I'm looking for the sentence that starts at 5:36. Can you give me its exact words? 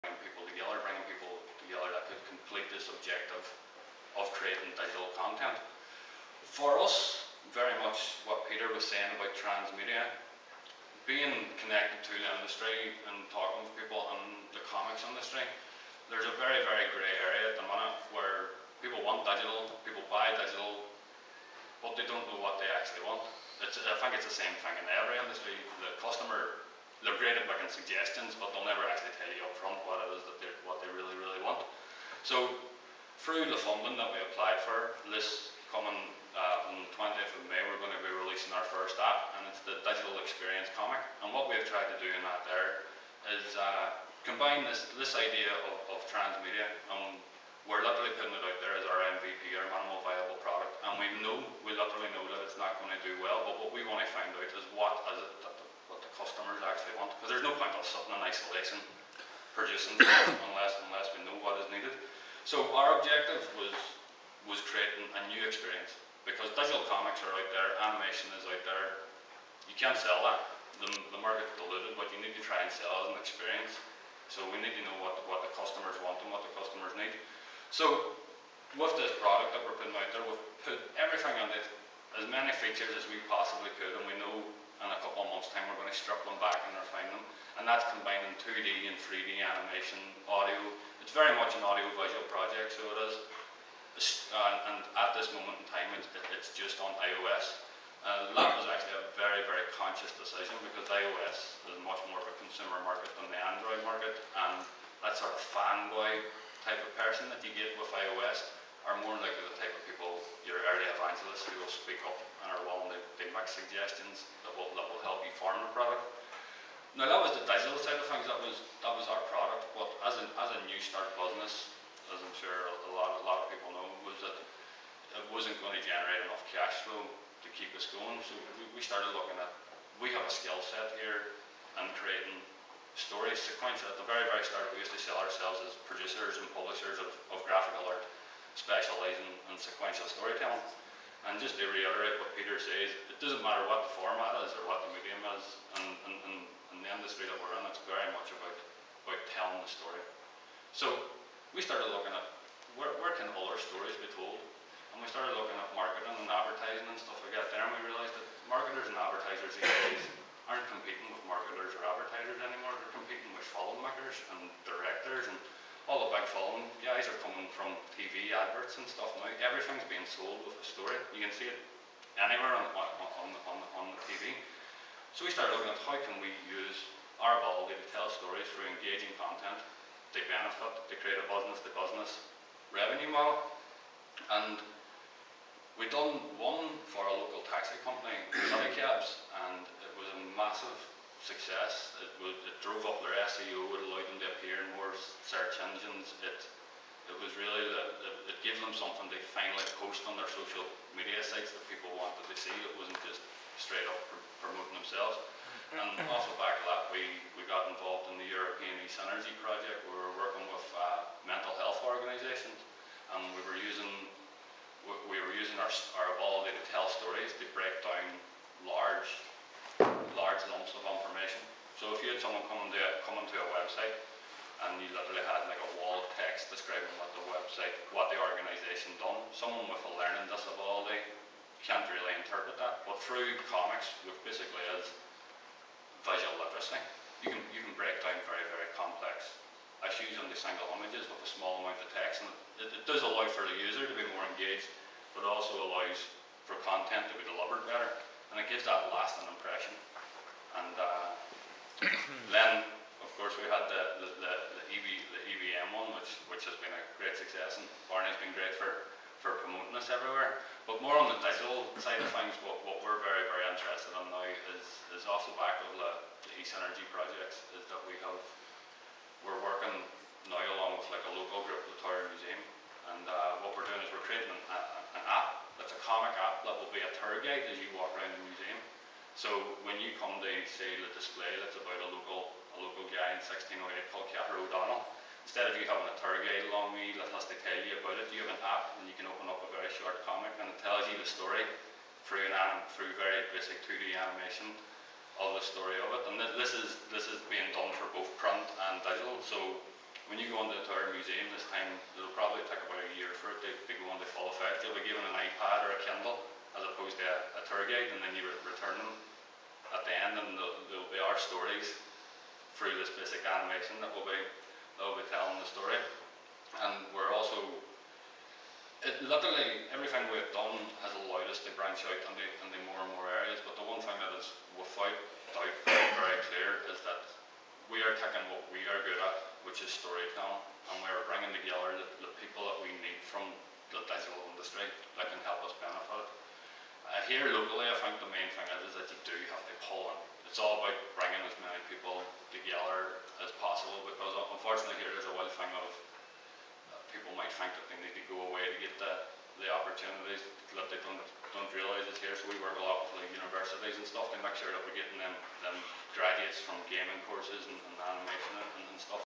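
Uh, here locally, I think the main thing is, is that you do have to pull in.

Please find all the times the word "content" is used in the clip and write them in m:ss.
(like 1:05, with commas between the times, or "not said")
0:05, 2:59, 4:06.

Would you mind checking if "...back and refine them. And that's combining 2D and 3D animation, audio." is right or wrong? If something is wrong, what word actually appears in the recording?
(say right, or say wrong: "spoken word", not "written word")
right.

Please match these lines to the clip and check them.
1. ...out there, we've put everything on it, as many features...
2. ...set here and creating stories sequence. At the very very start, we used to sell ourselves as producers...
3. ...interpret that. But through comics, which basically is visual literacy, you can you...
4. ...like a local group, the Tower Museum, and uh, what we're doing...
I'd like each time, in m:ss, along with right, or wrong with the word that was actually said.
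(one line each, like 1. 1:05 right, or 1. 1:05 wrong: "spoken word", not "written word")
1. 1:19 right
2. 2:10 right
3. 3:52 right
4. 4:30 right.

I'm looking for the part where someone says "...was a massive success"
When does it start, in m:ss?
3:09.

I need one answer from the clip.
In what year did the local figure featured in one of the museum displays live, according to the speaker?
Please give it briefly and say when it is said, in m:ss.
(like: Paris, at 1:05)
1608, at 4:43.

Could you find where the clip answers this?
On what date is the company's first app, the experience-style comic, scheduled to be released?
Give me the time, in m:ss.
0:36.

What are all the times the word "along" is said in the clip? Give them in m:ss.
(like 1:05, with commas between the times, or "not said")
4:30, 4:46.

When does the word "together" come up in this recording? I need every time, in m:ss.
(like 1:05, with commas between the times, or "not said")
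5:31, 5:42.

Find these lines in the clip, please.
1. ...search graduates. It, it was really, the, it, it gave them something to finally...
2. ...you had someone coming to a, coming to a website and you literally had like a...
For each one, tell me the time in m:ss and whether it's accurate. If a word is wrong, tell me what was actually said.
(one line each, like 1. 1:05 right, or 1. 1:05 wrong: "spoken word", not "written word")
1. 3:15 wrong: "engines", not "graduates"
2. 3:42 right.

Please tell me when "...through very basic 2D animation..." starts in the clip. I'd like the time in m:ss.
4:52.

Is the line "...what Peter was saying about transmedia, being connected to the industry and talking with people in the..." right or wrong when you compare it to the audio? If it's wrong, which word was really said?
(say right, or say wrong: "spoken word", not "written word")
right.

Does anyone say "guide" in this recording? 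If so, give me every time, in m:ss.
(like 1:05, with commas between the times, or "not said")
4:37, 4:46, 5:07.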